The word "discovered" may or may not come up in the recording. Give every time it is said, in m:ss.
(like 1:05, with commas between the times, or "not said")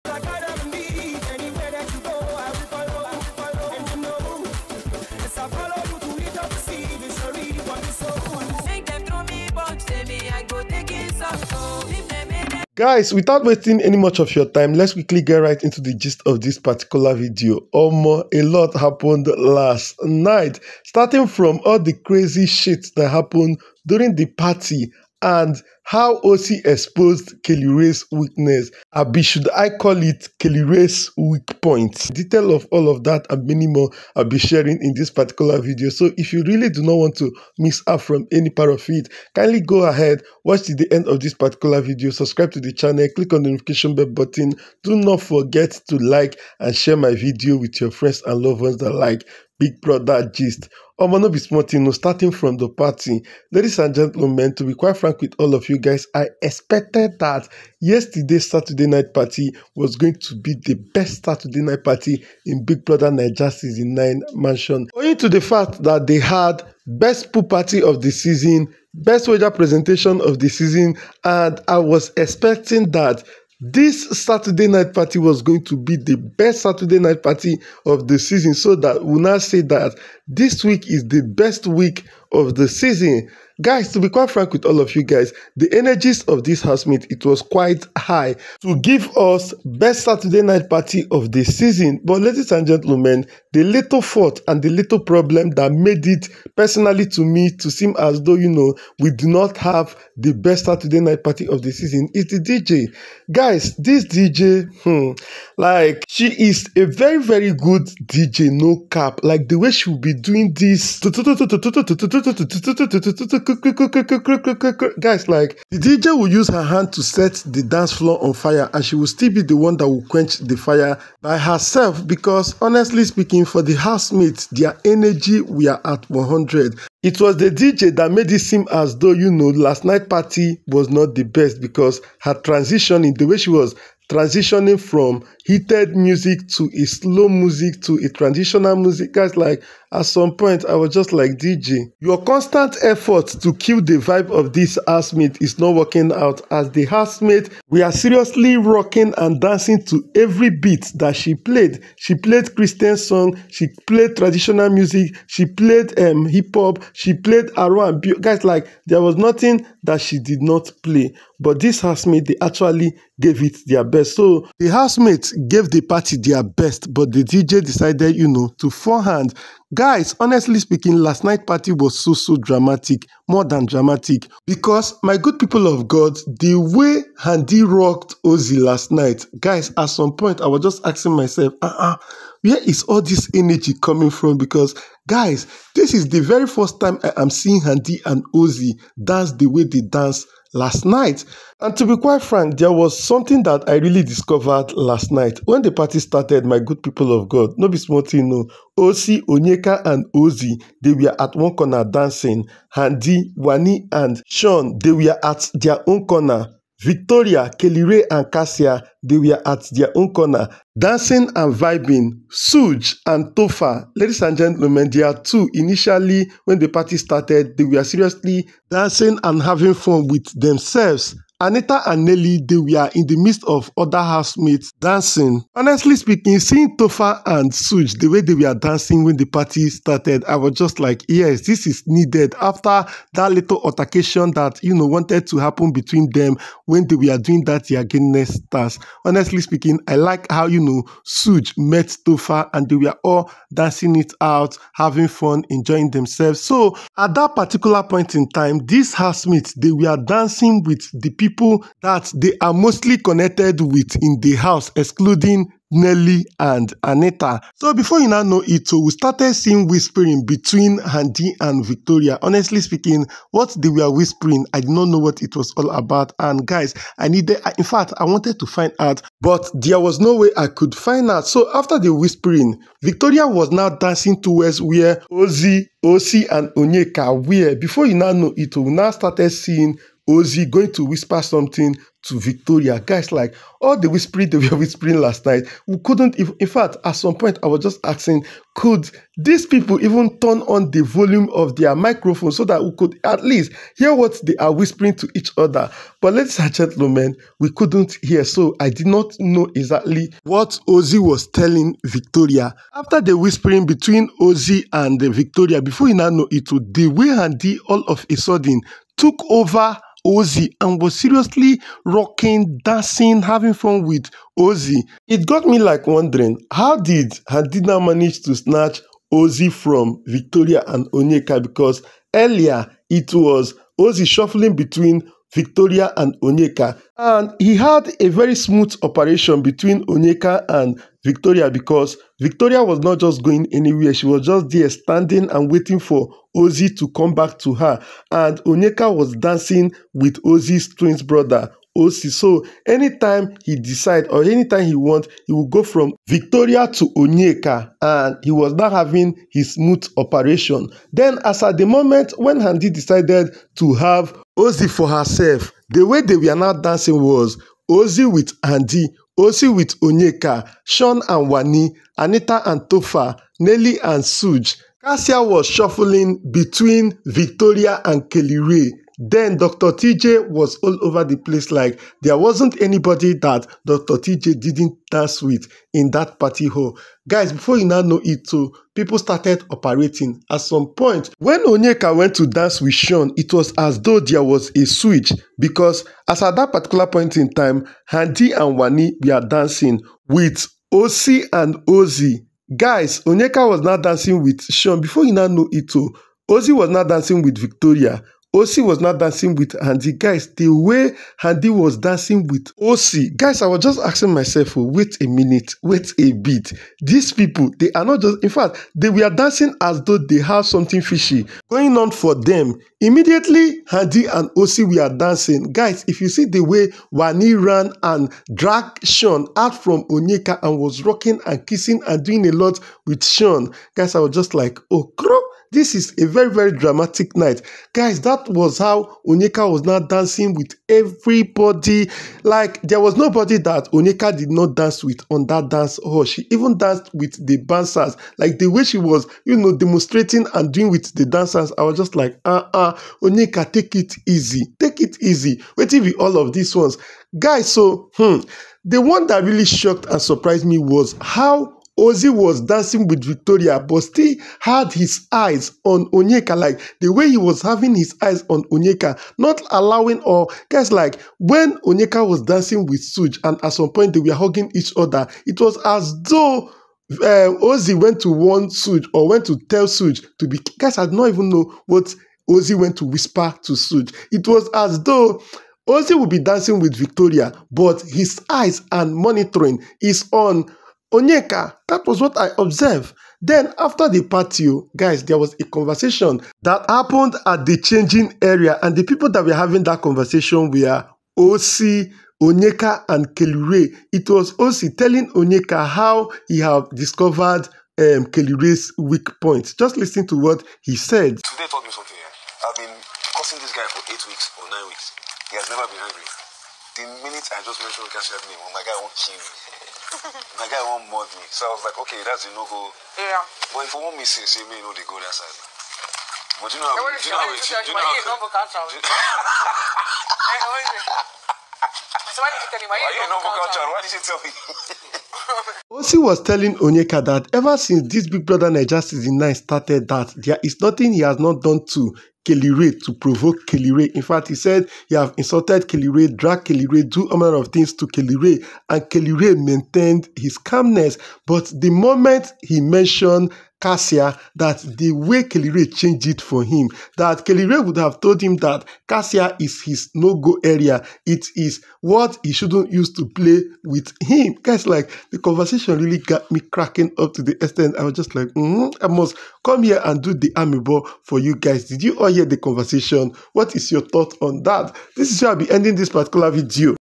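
3:14, 8:16.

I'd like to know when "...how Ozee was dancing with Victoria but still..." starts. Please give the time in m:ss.
7:31.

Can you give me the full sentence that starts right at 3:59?
Honestly speaking, I like how, you know, Suj met Topher and they were all dancing it out, having fun, enjoying themselves.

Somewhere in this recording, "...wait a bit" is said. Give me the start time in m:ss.
6:45.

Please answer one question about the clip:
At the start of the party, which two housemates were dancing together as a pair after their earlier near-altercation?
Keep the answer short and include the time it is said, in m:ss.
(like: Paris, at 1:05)
Suge and Tofa, at 3:32.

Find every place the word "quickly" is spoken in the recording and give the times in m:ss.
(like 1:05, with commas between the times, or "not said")
0:14.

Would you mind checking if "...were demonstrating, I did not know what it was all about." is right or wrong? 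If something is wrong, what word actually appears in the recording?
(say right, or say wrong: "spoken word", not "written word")
wrong: "whispering", not "demonstrating".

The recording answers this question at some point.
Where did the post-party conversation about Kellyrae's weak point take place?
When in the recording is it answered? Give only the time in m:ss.
8:07.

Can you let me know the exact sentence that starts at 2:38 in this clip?
Guys, like, there was nothing that she did not play.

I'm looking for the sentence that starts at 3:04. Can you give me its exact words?
Because guys, this is the very first time I am seeing Handi and Ozee dance the way they dance last night.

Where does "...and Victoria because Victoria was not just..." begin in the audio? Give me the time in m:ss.
5:30.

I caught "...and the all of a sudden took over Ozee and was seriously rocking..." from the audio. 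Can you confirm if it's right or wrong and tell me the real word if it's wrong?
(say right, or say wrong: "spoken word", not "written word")
right.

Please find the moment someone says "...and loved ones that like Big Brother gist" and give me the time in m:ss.
0:48.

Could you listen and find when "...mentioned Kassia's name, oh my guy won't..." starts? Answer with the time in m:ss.
8:27.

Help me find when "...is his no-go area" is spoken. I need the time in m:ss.
9:09.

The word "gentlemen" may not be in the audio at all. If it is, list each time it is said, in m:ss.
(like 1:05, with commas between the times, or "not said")
0:53, 1:32, 3:34, 4:56.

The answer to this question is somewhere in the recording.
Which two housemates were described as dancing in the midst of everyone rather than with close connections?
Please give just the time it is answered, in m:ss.
3:41.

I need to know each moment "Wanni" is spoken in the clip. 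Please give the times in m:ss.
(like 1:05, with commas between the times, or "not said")
3:23, 6:28, 6:56.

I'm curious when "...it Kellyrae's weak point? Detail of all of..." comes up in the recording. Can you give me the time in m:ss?
0:30.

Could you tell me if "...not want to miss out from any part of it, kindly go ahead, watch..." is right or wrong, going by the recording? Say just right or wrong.
right.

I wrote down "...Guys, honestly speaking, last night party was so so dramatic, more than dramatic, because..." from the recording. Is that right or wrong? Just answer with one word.
right.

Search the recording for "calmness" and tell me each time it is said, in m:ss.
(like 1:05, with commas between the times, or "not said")
9:00.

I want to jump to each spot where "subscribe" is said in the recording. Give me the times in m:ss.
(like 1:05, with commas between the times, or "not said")
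0:42.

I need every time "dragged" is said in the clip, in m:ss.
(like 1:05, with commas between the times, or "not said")
6:58, 8:56.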